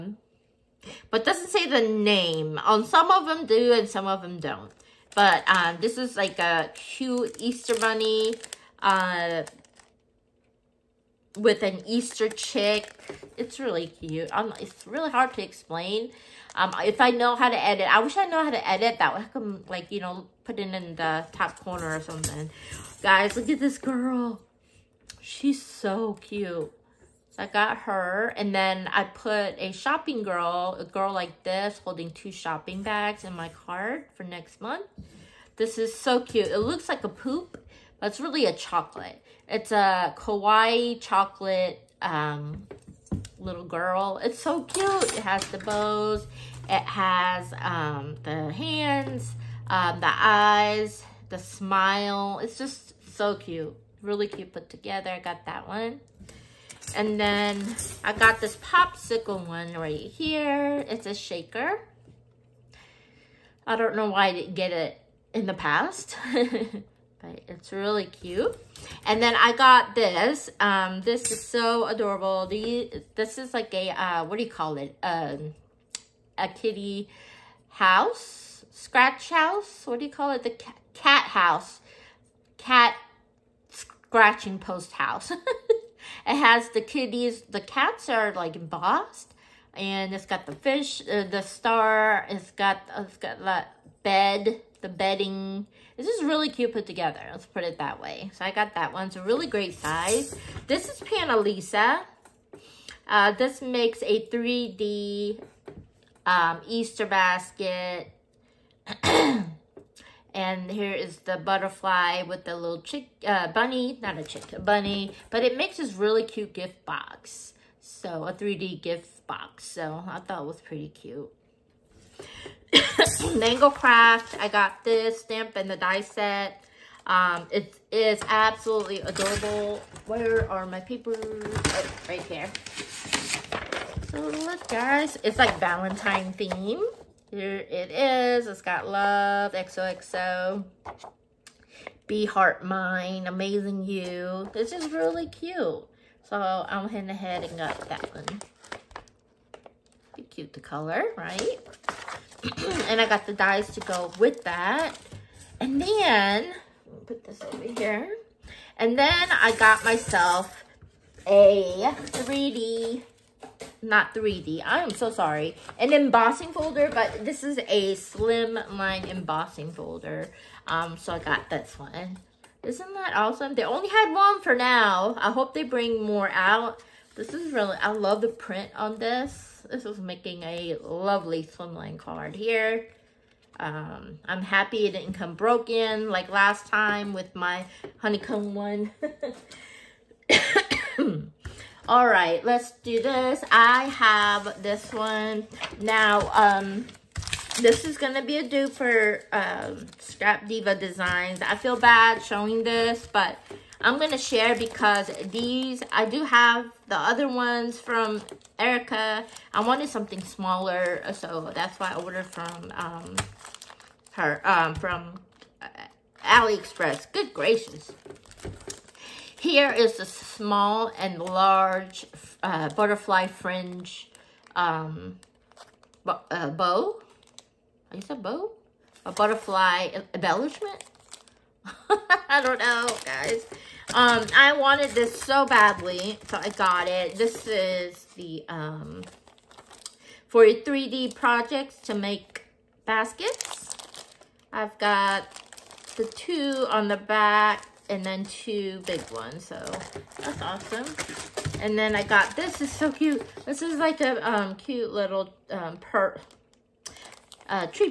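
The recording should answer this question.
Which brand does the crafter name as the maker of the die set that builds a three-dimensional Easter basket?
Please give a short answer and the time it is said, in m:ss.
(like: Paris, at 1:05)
Panalisa, at 1:41.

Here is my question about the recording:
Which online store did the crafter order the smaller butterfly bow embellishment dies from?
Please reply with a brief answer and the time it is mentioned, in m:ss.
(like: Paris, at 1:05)
AliExpress, at 3:36.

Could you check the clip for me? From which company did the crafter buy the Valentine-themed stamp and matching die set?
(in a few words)
Mango Craft.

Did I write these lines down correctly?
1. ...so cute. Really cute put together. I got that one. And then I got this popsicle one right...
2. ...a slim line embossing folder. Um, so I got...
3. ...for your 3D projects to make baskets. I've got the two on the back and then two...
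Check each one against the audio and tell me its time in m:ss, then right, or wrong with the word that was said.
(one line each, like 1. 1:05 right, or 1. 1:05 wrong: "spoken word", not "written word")
1. 0:53 right
2. 2:47 right
3. 4:00 right.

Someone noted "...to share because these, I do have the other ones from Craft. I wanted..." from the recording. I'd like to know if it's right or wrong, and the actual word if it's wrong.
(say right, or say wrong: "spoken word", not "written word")
wrong: "Erica", not "Craft".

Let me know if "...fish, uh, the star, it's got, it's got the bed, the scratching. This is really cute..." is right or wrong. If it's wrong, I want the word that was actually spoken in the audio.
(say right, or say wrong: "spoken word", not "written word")
wrong: "bedding", not "scratching".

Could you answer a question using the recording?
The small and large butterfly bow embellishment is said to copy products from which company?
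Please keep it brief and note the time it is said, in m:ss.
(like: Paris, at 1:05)
Scrap Diva Designs, at 3:19.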